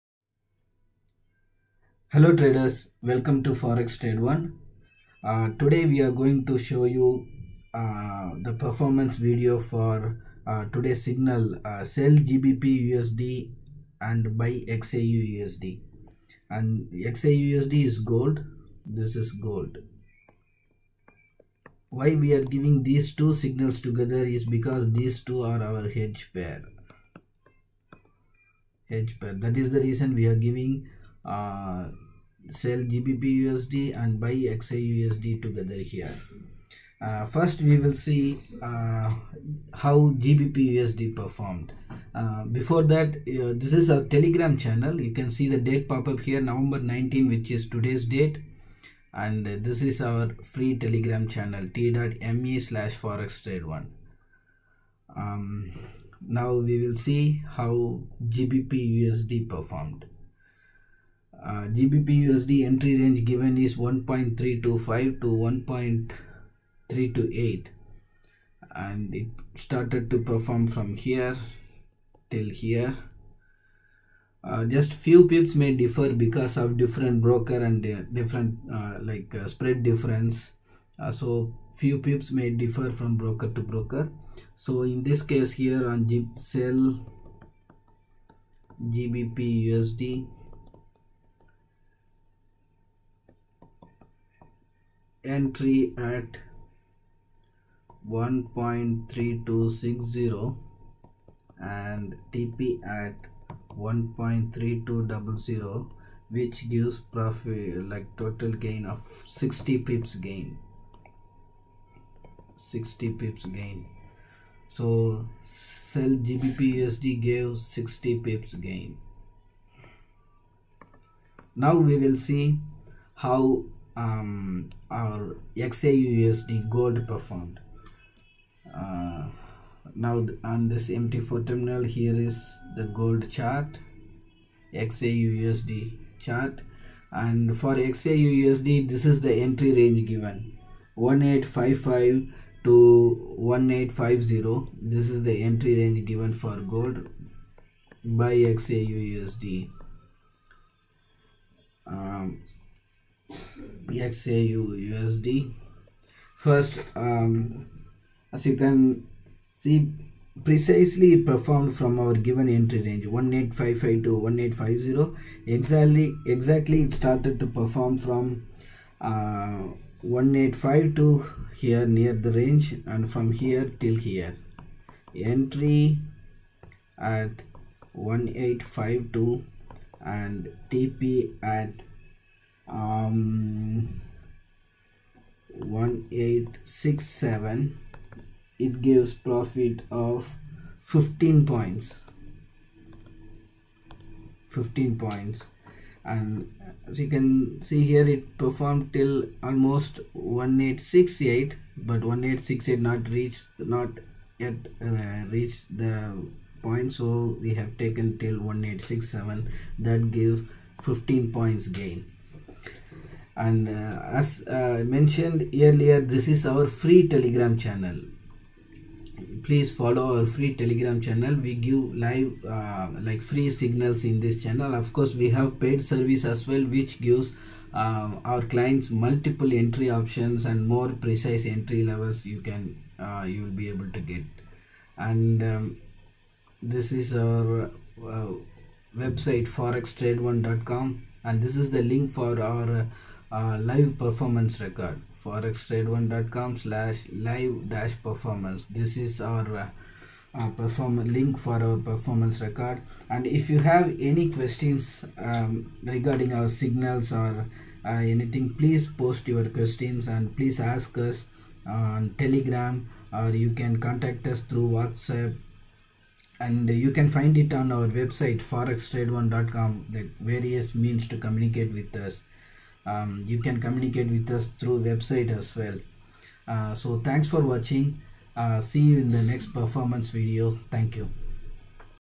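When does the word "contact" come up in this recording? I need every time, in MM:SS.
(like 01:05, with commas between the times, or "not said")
04:23.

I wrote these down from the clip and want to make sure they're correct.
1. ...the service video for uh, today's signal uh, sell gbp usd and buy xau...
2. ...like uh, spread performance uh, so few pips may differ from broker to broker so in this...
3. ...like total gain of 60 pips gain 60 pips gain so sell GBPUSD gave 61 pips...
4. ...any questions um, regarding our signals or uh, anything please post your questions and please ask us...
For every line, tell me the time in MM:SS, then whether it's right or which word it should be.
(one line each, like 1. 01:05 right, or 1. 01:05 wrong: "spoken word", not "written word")
1. 00:08 wrong: "performance", not "service"
2. 01:19 wrong: "difference", not "performance"
3. 01:47 wrong: "60", not "61"
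4. 04:14 right.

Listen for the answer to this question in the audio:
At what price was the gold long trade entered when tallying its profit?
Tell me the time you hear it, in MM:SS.
02:57.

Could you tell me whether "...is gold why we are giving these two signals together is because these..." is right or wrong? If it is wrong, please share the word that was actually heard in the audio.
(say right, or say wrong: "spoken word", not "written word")
right.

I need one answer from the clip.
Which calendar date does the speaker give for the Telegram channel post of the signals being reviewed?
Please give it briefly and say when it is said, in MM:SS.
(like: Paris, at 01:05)
November 19, at 00:46.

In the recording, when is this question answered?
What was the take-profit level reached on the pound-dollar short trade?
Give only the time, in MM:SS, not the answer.
01:43.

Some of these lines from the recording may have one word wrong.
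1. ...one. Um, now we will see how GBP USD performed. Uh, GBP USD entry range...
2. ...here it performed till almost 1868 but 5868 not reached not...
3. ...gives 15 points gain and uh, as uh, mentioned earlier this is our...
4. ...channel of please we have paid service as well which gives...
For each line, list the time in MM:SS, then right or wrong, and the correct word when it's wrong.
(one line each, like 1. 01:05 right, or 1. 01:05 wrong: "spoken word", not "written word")
1. 00:53 right
2. 03:17 wrong: "1868", not "5868"
3. 03:30 right
4. 03:44 wrong: "course", not "please".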